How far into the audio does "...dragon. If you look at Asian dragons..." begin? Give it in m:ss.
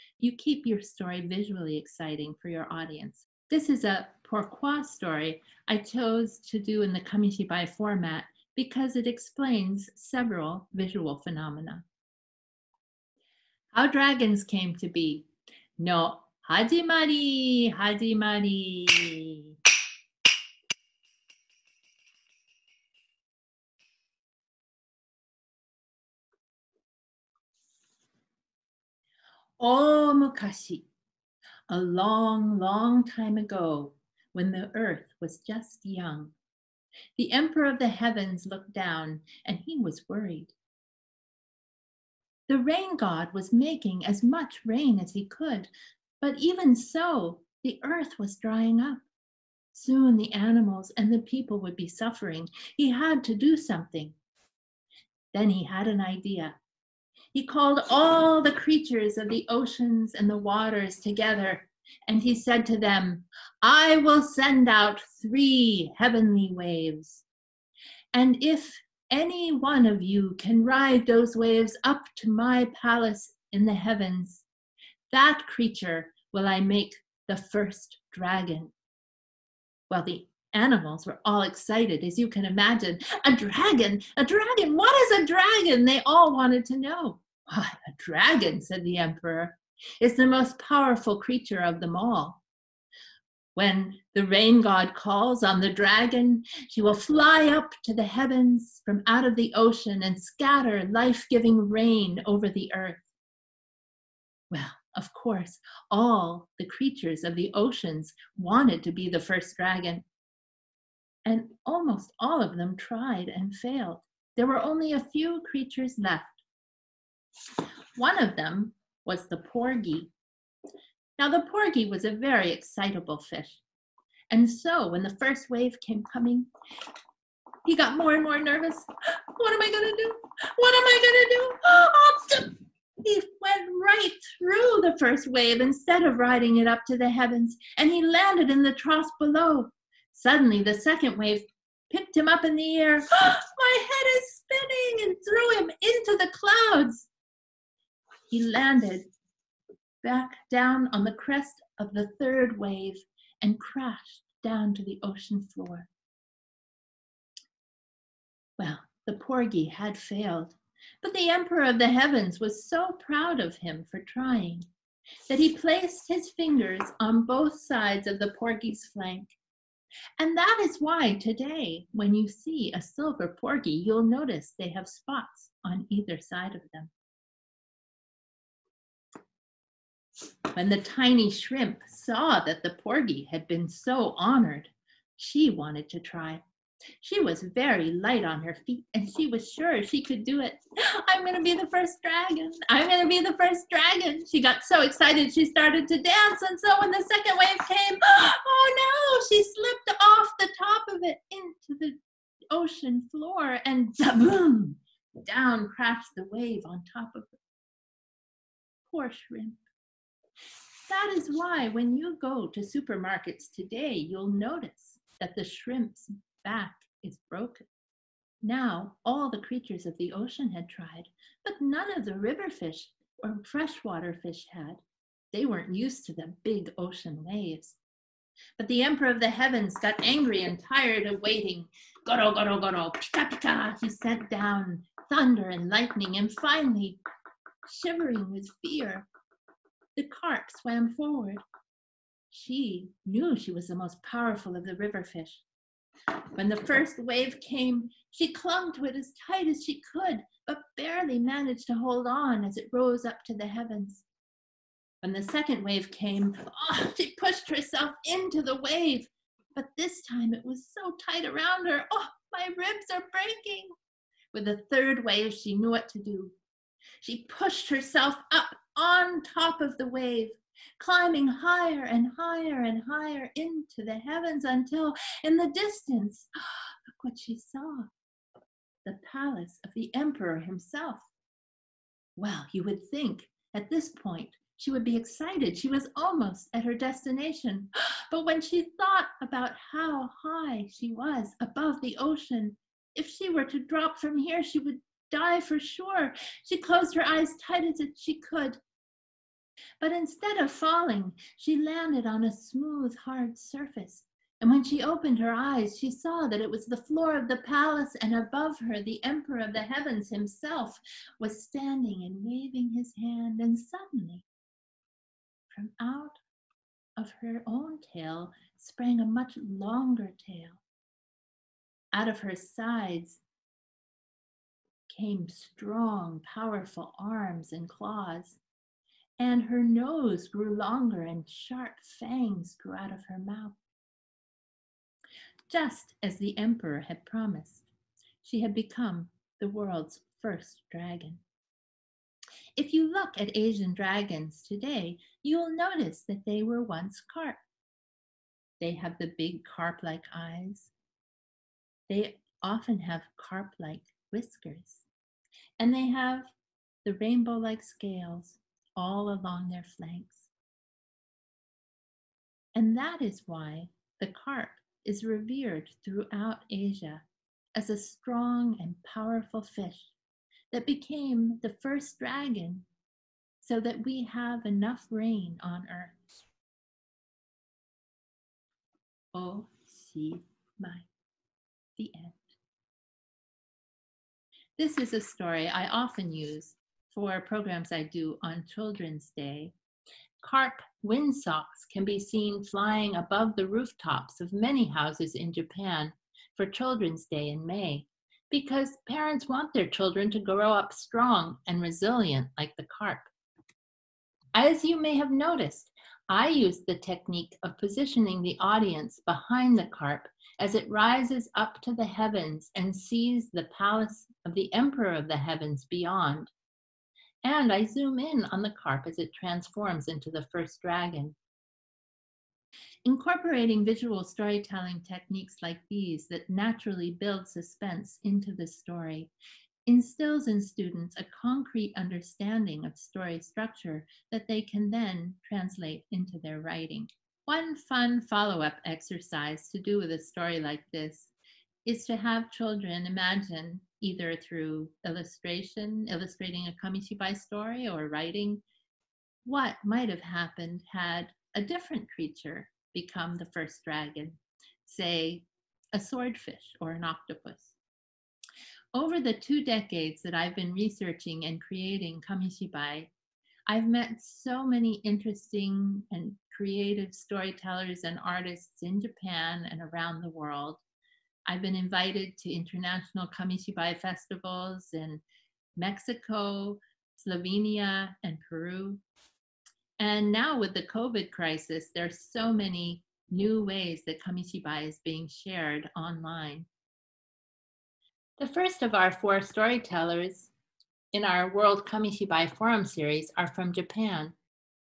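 5:40.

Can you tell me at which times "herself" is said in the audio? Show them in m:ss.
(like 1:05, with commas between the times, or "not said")
4:17, 4:27.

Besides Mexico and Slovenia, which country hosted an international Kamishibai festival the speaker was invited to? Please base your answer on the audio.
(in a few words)
Peru.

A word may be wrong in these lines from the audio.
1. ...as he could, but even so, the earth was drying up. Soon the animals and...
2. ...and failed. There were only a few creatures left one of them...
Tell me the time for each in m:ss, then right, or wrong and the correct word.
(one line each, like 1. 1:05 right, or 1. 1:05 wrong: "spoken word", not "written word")
1. 0:44 right
2. 1:53 right.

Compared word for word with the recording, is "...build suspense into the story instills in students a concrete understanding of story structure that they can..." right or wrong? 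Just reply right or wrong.
right.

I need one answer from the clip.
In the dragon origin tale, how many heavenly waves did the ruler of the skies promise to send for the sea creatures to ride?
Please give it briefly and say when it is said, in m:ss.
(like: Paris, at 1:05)
3, at 1:05.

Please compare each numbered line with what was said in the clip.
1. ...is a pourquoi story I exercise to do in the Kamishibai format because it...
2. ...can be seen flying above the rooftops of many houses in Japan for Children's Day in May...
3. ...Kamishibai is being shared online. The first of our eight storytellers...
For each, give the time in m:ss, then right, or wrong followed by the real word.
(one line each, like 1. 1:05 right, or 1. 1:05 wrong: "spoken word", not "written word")
1. 0:03 wrong: "chose", not "exercise"
2. 6:31 right
3. 8:04 wrong: "four", not "eight".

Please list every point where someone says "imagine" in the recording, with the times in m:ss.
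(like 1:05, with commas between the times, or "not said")
1:22, 7:22.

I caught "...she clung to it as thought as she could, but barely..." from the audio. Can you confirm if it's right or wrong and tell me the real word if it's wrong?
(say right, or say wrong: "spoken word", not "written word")
wrong: "tight", not "thought".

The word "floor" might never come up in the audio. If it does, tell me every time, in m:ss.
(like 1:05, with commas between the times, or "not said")
2:35, 3:23, 5:06.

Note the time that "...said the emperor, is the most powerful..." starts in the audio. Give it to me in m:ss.
1:28.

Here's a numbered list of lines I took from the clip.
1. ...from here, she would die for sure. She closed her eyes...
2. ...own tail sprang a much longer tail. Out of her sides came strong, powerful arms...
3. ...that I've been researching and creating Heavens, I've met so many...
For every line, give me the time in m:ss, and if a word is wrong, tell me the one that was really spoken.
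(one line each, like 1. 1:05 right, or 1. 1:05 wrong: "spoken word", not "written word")
1. 4:53 right
2. 5:17 right
3. 7:40 wrong: "Kamishibai", not "Heavens".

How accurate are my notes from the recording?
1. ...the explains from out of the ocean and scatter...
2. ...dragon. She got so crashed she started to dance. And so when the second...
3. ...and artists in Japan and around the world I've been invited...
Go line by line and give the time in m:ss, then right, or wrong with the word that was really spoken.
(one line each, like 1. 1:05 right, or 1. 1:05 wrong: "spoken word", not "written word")
1. 1:37 wrong: "heavens", not "explains"
2. 3:13 wrong: "excited", not "crashed"
3. 7:47 right.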